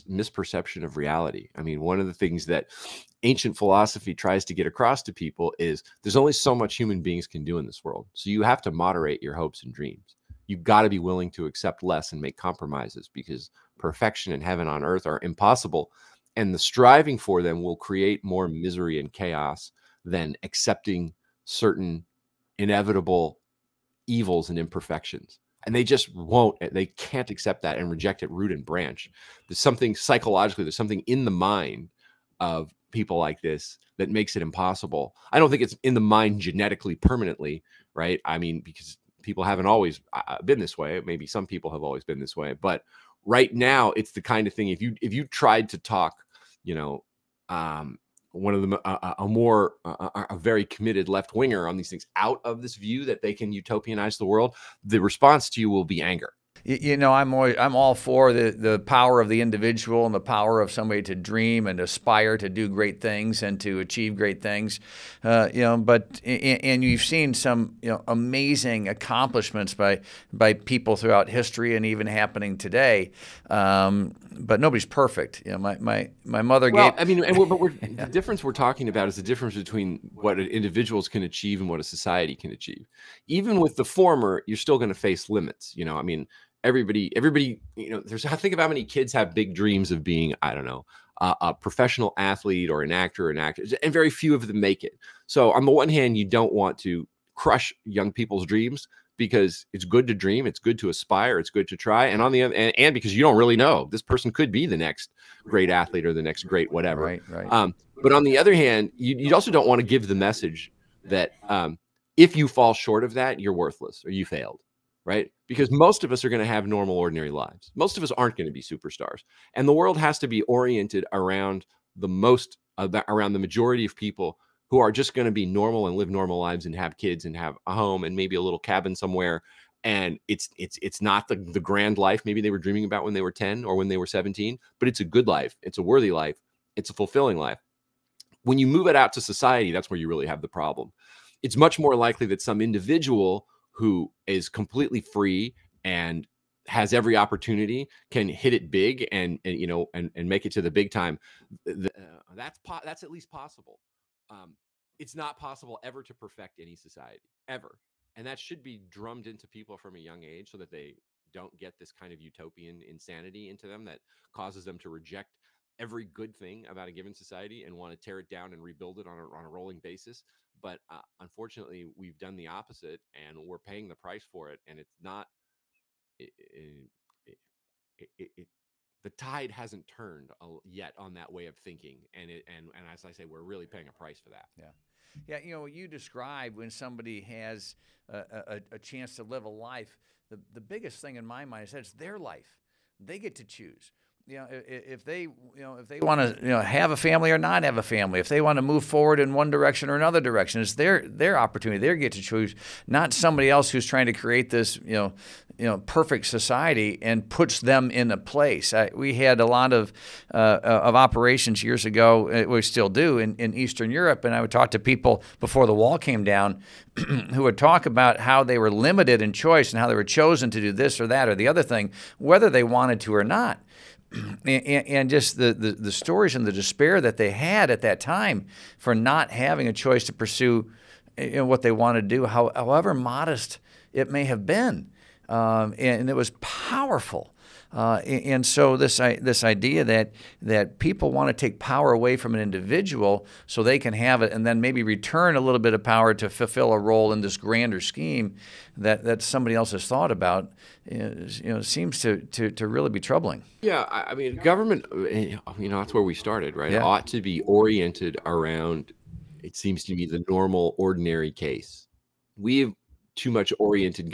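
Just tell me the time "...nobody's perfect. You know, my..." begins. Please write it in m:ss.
1:14.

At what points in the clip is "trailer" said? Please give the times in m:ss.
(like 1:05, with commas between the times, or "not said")
not said.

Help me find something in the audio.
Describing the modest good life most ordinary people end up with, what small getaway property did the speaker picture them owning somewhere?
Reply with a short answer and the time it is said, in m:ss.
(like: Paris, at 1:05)
a little cabin, at 2:08.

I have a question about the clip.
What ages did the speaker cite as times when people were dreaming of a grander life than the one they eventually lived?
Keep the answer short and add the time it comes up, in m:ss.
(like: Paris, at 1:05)
10 or 17, at 2:13.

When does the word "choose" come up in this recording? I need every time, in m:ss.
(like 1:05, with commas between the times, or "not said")
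3:13, 3:22.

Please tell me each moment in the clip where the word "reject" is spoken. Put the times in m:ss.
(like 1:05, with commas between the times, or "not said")
0:27, 2:44.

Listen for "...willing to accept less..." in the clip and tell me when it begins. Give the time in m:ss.
0:10.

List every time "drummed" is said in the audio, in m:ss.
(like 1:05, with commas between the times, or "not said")
2:38.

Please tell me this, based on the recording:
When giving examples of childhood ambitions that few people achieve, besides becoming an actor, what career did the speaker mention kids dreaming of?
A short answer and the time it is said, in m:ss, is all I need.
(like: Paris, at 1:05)
professional athlete, at 1:31.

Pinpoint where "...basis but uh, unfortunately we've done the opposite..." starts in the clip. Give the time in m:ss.
2:49.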